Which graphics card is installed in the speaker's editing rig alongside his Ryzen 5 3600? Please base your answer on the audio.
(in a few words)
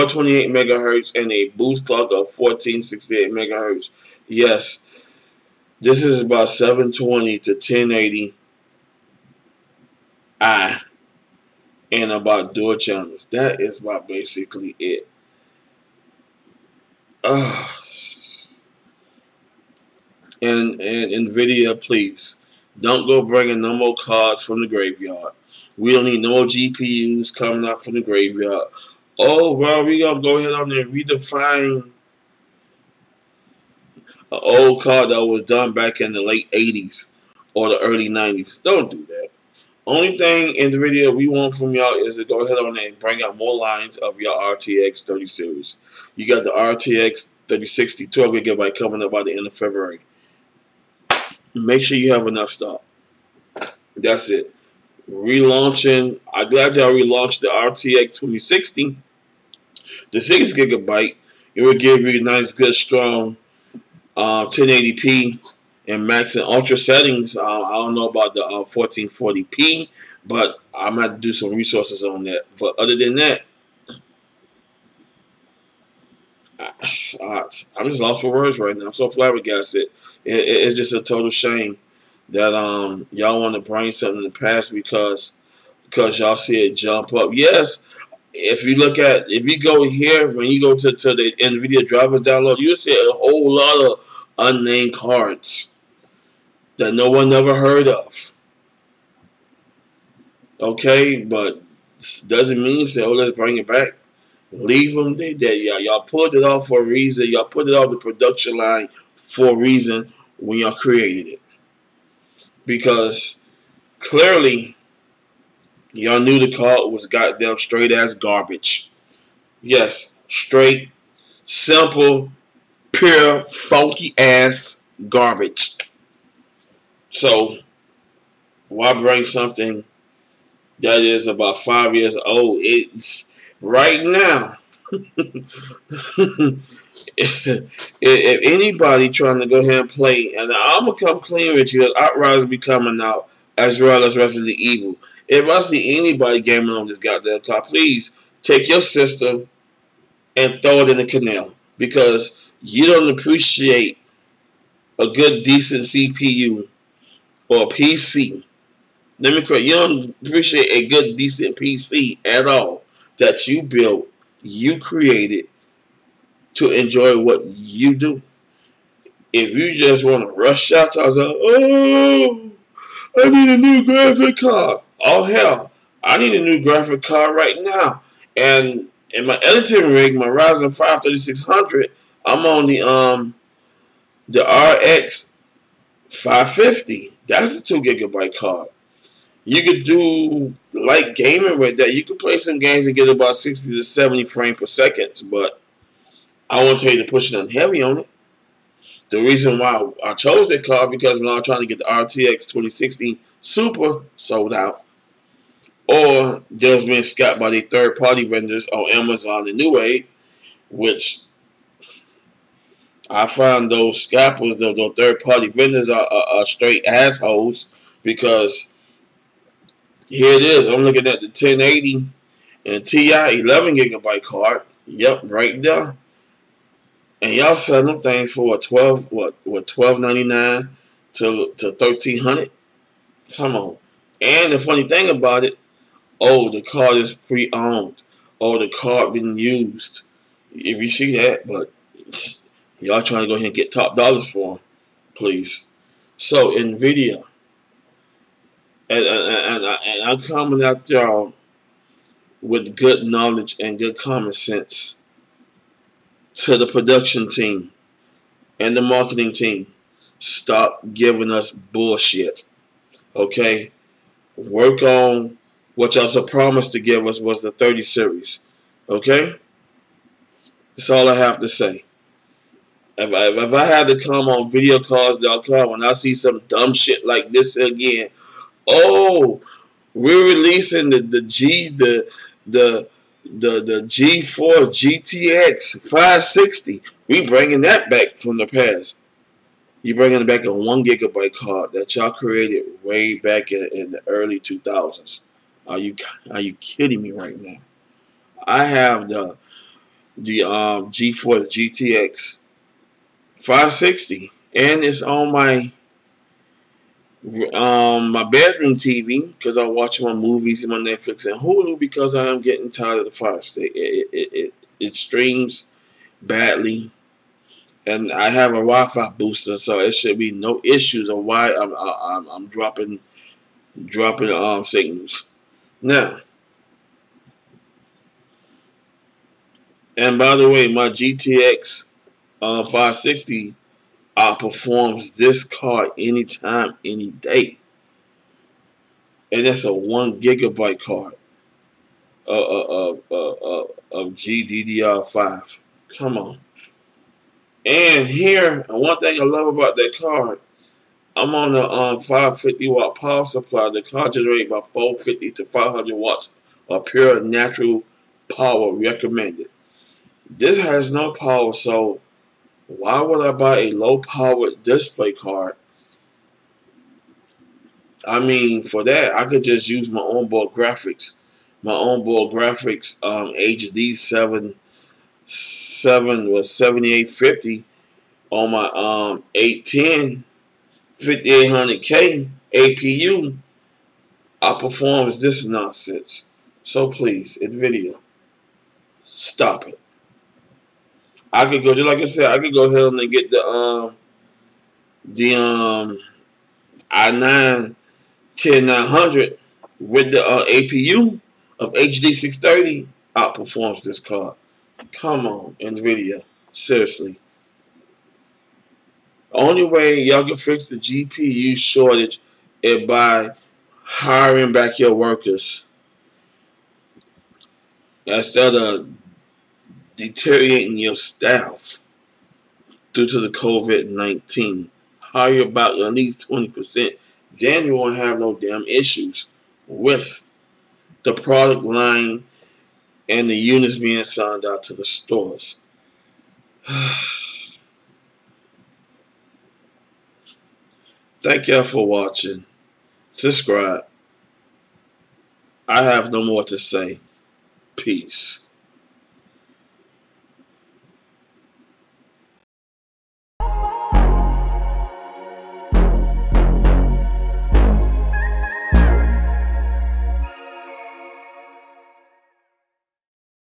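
RX 550.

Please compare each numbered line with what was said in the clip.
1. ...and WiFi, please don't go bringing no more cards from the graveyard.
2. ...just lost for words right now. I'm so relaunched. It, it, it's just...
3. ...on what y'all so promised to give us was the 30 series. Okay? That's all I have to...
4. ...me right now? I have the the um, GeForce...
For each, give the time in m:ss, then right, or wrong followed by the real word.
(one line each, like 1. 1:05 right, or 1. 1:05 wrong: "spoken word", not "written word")
1. 0:20 wrong: "Nvidia", not "WiFi"
2. 1:17 wrong: "flabbergasted", not "relaunched"
3. 4:24 right
4. 4:57 right.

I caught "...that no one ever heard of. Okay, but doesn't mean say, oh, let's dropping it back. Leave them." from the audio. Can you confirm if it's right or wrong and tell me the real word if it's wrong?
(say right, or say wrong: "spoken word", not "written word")
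wrong: "bring", not "dropping".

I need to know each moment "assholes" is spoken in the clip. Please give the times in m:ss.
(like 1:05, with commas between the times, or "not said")
3:36.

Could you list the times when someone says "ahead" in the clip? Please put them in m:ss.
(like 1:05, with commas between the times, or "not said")
0:30, 0:42, 2:19, 4:03, 6:32.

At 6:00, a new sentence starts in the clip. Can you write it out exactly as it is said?
This has no power, so why would I buy a low-powered display card?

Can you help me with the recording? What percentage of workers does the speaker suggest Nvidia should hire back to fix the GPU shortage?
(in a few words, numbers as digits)
20%.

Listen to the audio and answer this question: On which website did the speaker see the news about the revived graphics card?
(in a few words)
videocardz.com.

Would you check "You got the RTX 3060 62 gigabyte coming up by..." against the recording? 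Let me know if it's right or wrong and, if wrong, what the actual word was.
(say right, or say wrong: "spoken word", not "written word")
wrong: "12", not "62".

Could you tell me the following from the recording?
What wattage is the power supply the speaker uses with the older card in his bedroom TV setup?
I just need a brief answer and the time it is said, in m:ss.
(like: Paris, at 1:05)
550 watt, at 5:51.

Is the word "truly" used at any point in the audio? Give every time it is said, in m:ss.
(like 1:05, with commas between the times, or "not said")
not said.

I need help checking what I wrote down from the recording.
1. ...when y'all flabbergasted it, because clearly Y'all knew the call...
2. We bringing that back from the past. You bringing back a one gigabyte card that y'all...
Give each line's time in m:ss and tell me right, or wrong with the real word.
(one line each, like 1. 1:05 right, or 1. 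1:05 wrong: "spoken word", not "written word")
1. 1:50 wrong: "created", not "flabbergasted"
2. 4:47 right.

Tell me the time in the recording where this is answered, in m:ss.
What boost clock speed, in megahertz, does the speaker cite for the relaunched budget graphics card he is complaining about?
0:02.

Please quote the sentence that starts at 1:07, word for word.
Uh, I don't know about the uh, 1440p, but I might do some resources on that.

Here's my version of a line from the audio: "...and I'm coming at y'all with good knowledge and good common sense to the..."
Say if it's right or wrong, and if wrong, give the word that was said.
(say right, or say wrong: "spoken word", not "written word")
right.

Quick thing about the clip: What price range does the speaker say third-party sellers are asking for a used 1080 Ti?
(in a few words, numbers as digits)
1299 to 1300.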